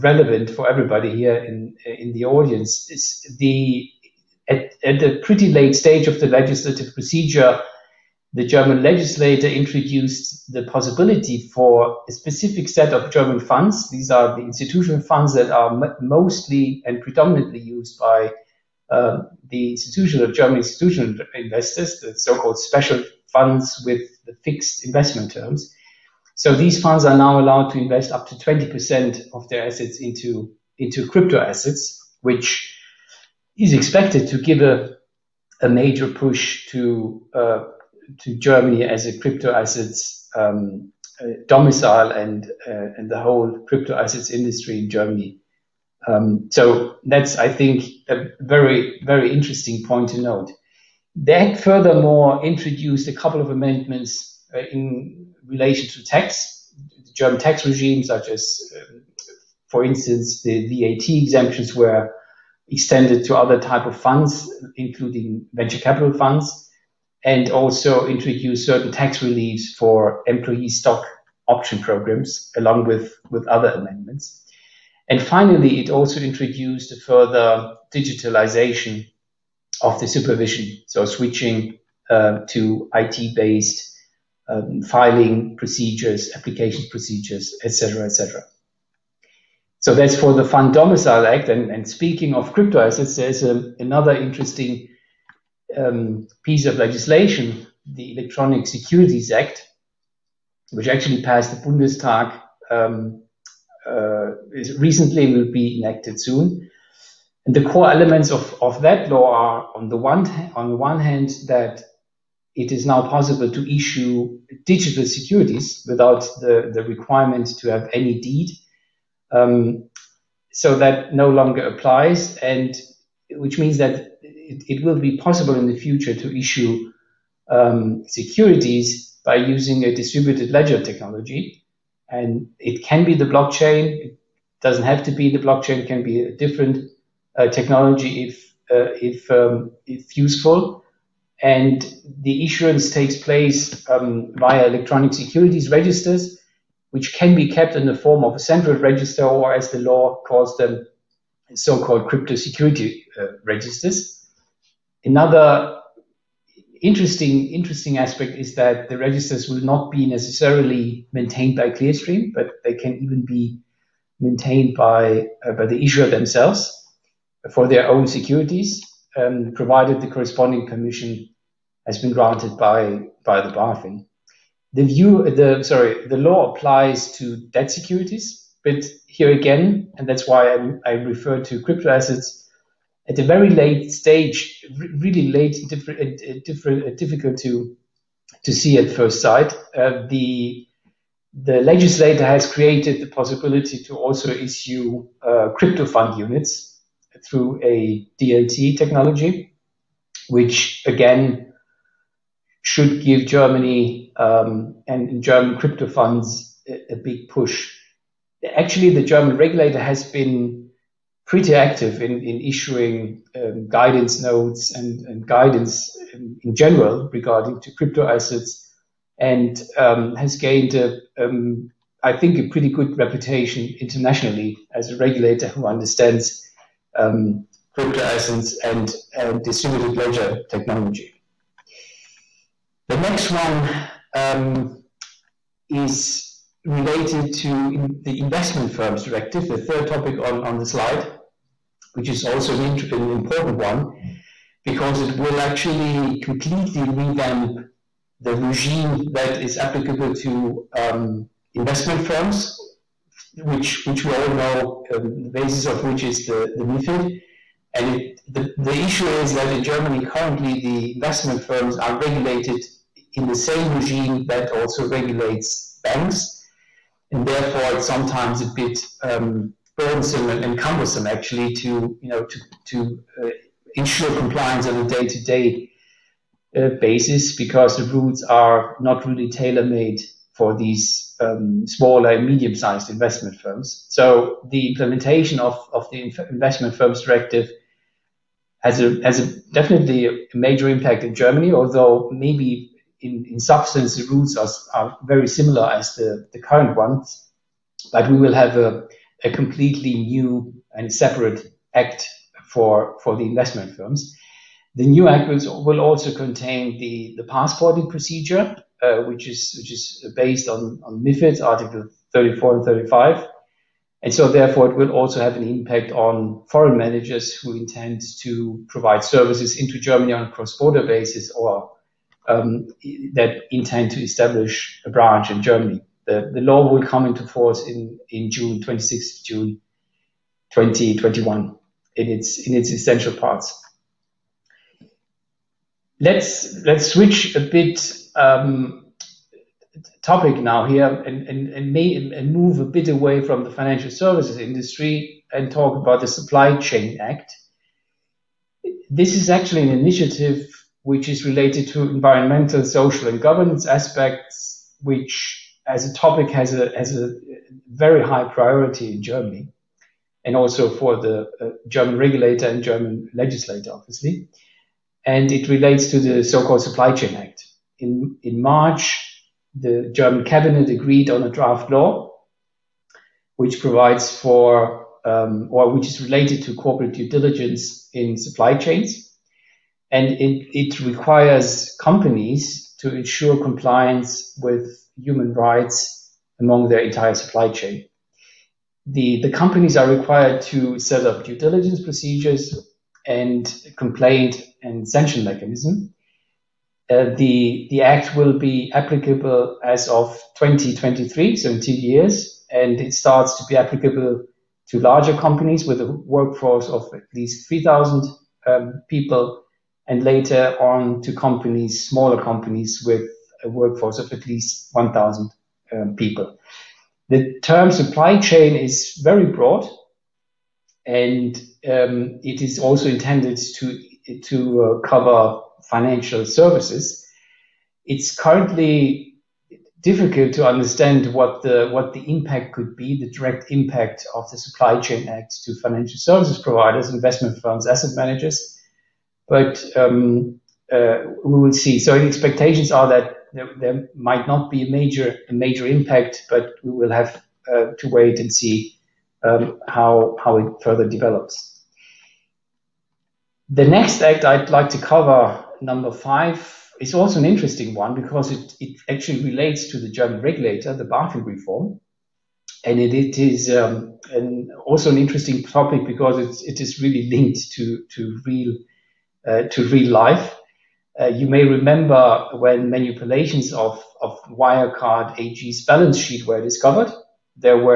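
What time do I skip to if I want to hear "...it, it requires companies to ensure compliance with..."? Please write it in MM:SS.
06:20.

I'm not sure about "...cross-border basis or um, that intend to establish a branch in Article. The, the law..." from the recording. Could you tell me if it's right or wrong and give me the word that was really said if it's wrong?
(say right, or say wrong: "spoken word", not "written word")
wrong: "Germany", not "Article".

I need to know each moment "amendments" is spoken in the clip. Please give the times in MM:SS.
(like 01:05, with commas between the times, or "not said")
00:53, 01:13.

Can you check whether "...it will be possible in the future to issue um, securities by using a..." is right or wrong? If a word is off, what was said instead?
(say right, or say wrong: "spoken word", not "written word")
right.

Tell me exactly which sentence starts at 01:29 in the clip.
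So that's for the Fund Domicile Act.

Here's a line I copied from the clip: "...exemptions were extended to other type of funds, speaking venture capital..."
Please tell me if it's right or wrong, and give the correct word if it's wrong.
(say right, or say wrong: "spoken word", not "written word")
wrong: "including", not "speaking".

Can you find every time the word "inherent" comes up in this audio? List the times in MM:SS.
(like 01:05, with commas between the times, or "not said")
not said.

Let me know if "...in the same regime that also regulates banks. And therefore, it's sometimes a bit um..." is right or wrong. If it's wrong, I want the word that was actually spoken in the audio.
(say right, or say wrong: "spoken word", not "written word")
right.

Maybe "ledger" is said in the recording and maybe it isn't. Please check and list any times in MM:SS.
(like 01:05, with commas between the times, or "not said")
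02:10, 03:49.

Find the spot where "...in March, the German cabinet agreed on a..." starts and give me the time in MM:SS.
06:08.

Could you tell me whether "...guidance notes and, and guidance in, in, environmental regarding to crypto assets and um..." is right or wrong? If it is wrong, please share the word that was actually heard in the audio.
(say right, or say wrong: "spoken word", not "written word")
wrong: "general", not "environmental".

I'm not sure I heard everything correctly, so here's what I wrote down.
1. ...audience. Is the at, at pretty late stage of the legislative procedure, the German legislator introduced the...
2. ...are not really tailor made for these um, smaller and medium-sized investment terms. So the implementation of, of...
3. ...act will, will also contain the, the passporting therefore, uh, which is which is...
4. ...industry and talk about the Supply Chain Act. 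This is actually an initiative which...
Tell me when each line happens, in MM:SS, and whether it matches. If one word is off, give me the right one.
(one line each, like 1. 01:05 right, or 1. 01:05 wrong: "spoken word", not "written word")
1. 00:02 right
2. 04:38 wrong: "firms", not "terms"
3. 05:05 wrong: "procedure", not "therefore"
4. 05:44 right.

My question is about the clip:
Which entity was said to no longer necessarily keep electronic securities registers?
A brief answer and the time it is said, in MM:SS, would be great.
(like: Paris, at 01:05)
Clearstream, at 02:41.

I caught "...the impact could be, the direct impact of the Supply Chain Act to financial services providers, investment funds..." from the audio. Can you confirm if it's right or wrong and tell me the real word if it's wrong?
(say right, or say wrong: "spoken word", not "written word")
right.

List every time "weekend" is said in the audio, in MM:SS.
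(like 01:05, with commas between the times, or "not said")
not said.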